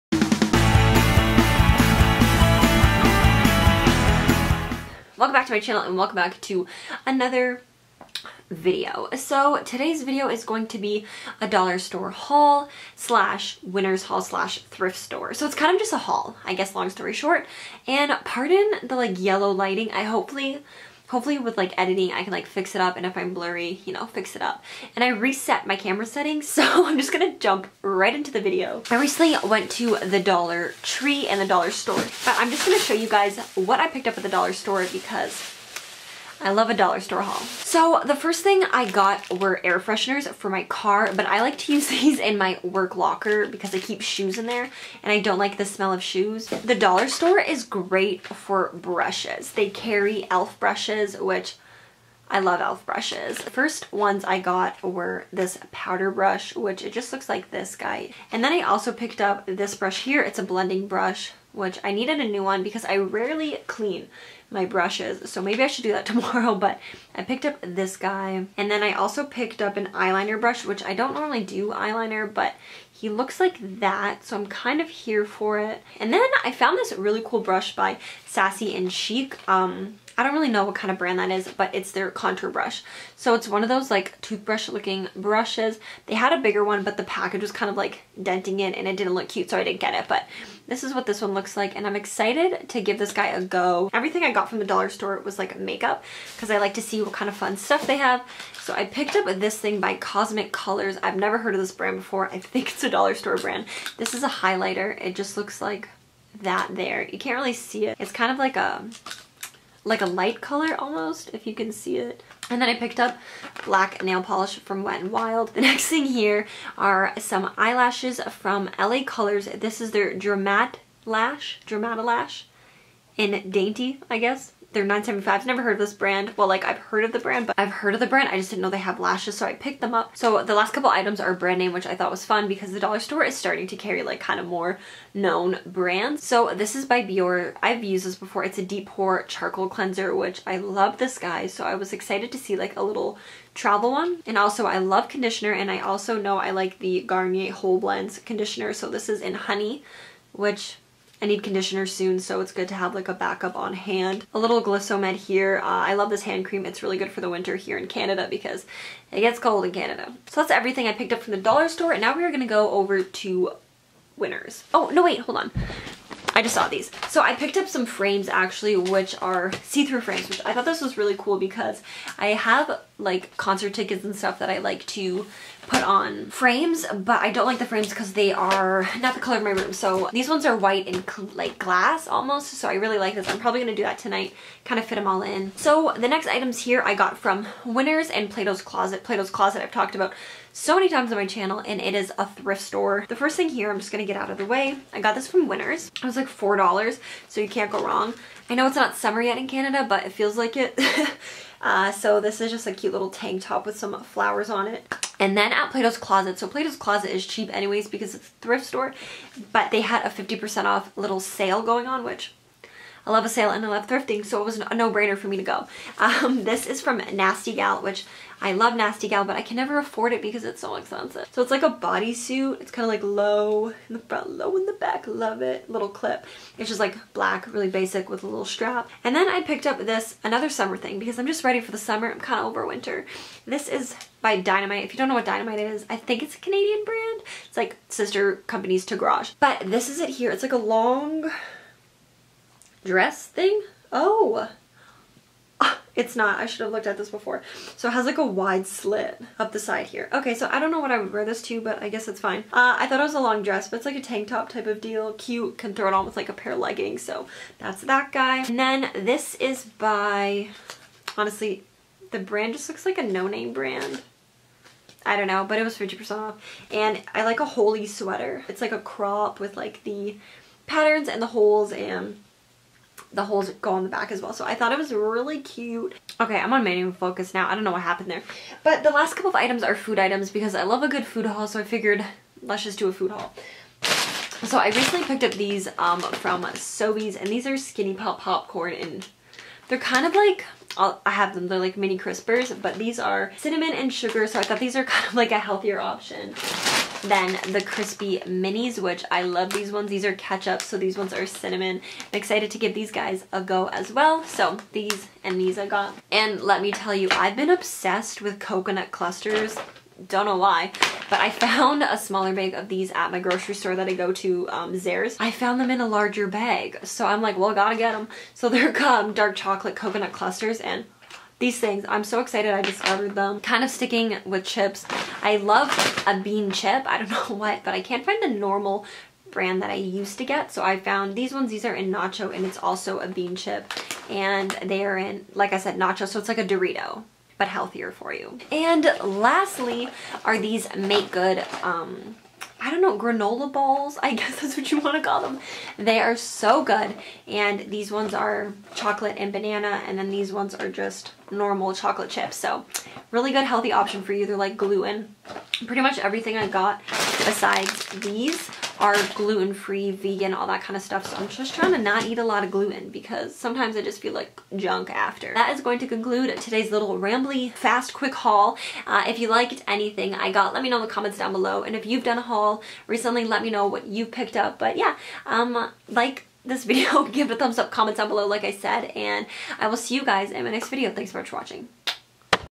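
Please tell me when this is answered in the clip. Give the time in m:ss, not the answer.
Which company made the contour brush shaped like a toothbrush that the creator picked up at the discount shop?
1:18.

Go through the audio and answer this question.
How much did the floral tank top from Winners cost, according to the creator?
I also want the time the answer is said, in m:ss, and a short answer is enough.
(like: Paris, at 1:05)
$4, at 3:16.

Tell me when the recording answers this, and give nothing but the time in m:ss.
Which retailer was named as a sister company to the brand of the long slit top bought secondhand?
3:58.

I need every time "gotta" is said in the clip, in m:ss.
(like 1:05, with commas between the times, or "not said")
5:17.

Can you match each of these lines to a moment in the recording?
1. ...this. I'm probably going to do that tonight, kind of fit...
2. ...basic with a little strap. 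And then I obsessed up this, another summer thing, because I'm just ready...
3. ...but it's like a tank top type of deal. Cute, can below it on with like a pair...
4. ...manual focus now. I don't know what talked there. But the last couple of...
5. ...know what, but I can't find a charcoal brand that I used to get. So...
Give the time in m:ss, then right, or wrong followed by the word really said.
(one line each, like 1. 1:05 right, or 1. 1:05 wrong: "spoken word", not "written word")
1. 3:03 right
2. 3:47 wrong: "picked", not "obsessed"
3. 4:13 wrong: "throw", not "below"
4. 4:36 wrong: "happened", not "talked"
5. 5:27 wrong: "normal", not "charcoal".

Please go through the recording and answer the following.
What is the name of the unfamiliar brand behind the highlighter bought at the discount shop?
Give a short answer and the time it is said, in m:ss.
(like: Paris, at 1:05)
Cosmic Colors, at 1:39.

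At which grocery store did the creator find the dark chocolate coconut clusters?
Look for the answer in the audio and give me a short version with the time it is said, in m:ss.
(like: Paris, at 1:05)
Zehrs, at 5:14.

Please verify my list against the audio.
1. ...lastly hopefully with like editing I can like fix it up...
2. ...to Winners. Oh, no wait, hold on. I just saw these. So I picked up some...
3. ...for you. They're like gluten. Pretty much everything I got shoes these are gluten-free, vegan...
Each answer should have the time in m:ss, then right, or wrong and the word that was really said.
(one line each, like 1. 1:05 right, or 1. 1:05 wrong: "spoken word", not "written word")
1. 0:20 wrong: "hopefully", not "lastly"
2. 2:43 right
3. 5:54 wrong: "besides", not "shoes".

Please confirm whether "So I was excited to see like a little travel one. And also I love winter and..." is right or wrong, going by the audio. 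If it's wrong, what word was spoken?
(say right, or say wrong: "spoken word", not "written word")
wrong: "conditioner", not "winter".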